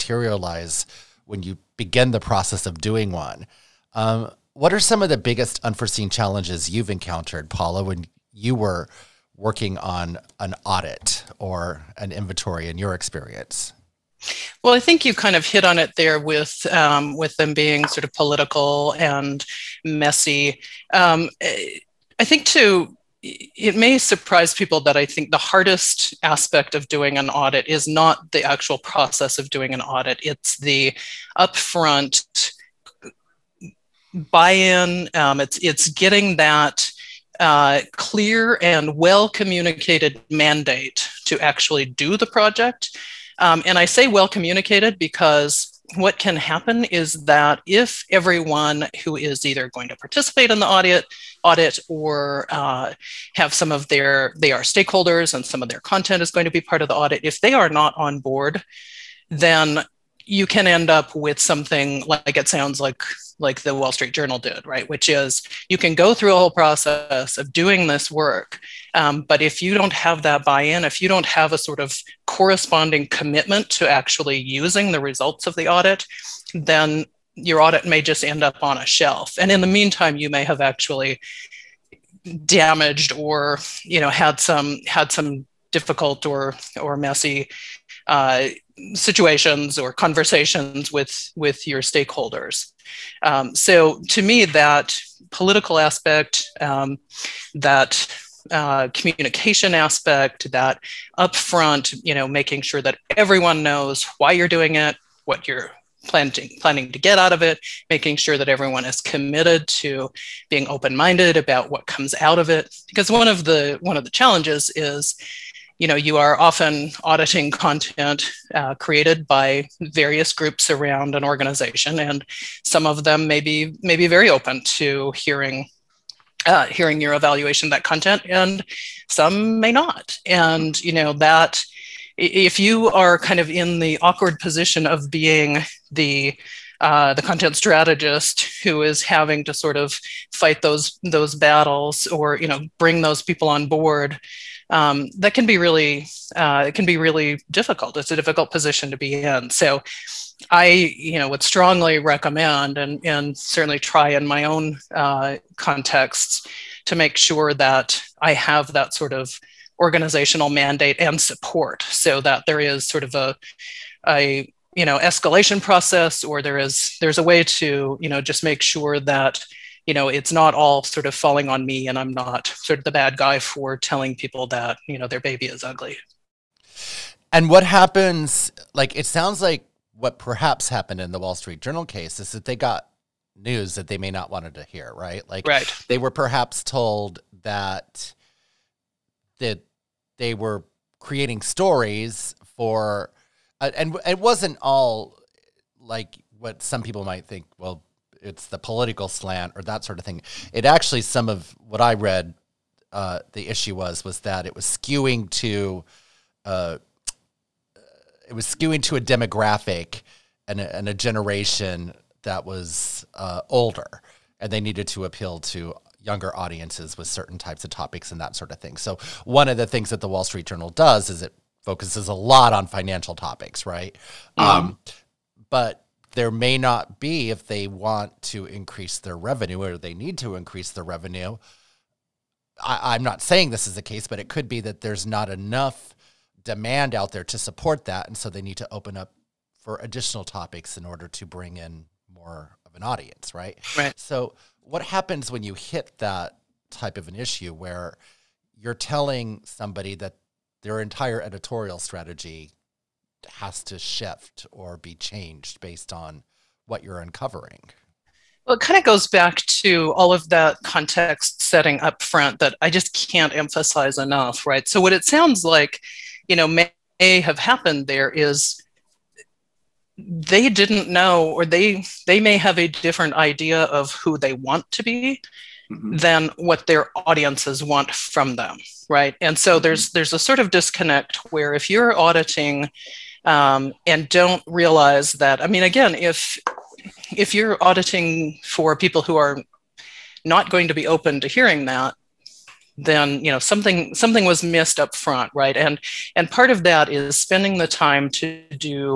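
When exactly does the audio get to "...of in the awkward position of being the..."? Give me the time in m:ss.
2:13.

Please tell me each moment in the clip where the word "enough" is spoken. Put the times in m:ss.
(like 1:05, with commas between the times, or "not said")
3:55, 4:23.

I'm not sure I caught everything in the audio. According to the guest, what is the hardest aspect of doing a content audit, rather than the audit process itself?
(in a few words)
upfront buy-in.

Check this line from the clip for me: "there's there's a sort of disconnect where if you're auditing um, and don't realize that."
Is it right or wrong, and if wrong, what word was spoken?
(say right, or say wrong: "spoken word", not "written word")
right.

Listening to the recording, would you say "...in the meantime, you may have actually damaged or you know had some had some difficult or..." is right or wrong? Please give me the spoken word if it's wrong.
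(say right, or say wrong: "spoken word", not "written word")
right.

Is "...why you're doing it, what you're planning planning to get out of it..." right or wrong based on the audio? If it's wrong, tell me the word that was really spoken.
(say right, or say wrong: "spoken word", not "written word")
right.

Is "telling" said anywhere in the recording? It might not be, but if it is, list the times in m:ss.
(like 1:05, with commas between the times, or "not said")
2:53, 4:08.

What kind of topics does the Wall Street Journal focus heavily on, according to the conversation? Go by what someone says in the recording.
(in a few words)
financial topics.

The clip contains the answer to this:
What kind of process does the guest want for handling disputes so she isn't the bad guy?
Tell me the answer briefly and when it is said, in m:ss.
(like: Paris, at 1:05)
escalation process, at 2:44.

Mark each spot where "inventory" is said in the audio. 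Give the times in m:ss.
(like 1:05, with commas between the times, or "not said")
0:12.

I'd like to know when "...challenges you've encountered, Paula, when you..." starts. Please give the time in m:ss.
0:06.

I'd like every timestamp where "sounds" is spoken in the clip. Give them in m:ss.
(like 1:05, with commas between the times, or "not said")
1:02, 2:59, 4:25.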